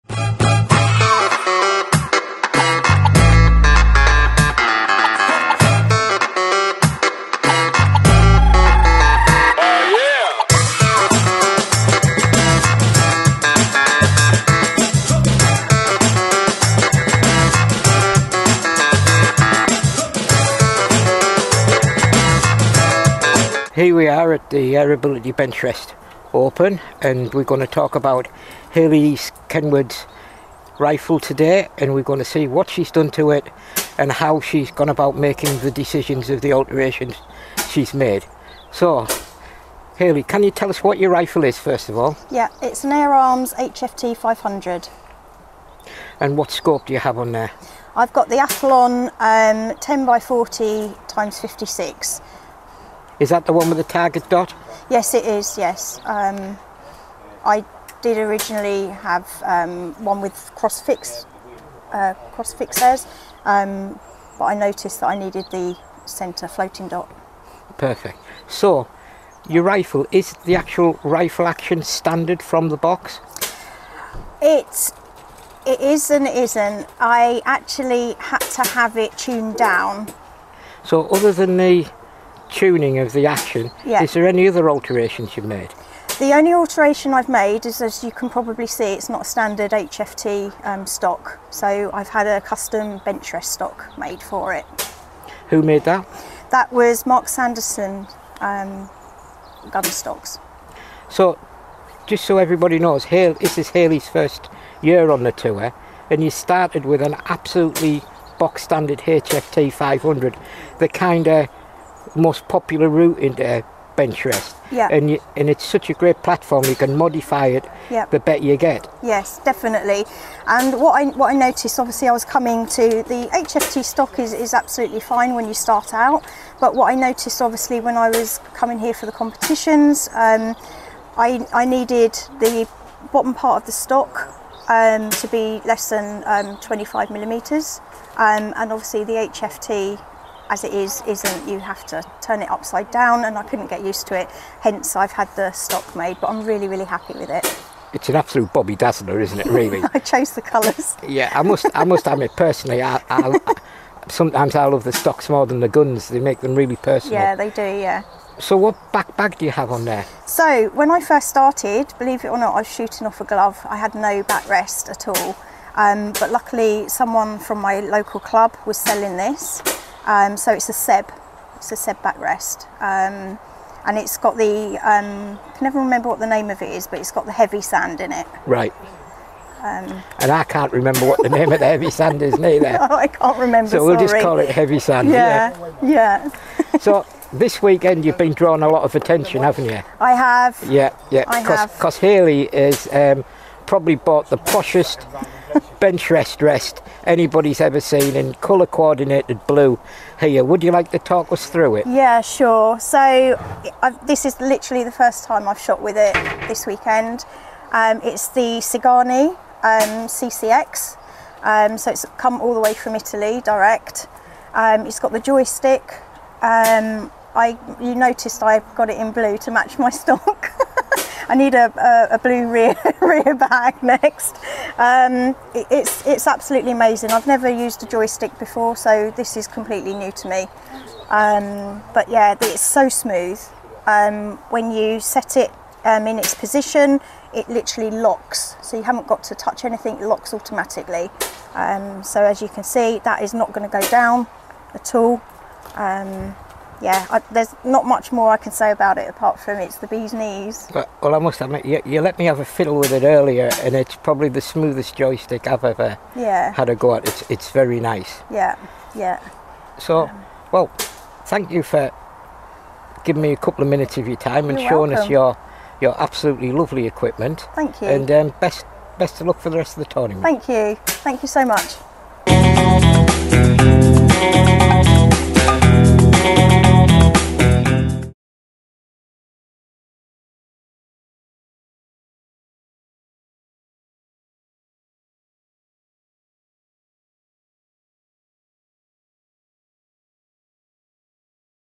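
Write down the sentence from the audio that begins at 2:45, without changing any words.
Um, but luckily, someone from my local club was selling this um, so it's a Seb, it's a Seb backrest.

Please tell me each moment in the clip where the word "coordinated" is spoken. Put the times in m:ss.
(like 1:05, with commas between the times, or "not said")
3:18.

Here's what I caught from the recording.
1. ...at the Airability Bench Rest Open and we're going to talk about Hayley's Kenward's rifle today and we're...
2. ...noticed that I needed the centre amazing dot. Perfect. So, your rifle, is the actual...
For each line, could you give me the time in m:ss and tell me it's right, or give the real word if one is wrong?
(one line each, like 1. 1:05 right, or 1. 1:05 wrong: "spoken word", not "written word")
1. 0:24 right
2. 1:04 wrong: "floating", not "amazing".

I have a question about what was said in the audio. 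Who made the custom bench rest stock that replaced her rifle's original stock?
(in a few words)
Mark Sanderson.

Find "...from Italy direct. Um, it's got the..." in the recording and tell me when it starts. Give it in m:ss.
3:32.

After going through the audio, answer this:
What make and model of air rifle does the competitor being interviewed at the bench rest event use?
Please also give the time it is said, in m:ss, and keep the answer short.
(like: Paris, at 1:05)
Air Arms HFT 500, at 0:42.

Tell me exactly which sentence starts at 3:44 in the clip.
Um, it, it's, it's absolutely amazing.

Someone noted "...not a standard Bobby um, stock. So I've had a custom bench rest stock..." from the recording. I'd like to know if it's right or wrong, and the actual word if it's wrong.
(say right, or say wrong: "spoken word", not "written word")
wrong: "HFT", not "Bobby".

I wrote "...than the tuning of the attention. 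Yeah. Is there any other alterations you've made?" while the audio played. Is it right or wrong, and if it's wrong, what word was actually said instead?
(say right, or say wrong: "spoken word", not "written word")
wrong: "action", not "attention".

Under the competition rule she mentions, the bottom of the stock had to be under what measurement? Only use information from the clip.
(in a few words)
25 millimeters.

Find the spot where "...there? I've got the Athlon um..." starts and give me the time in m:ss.
0:47.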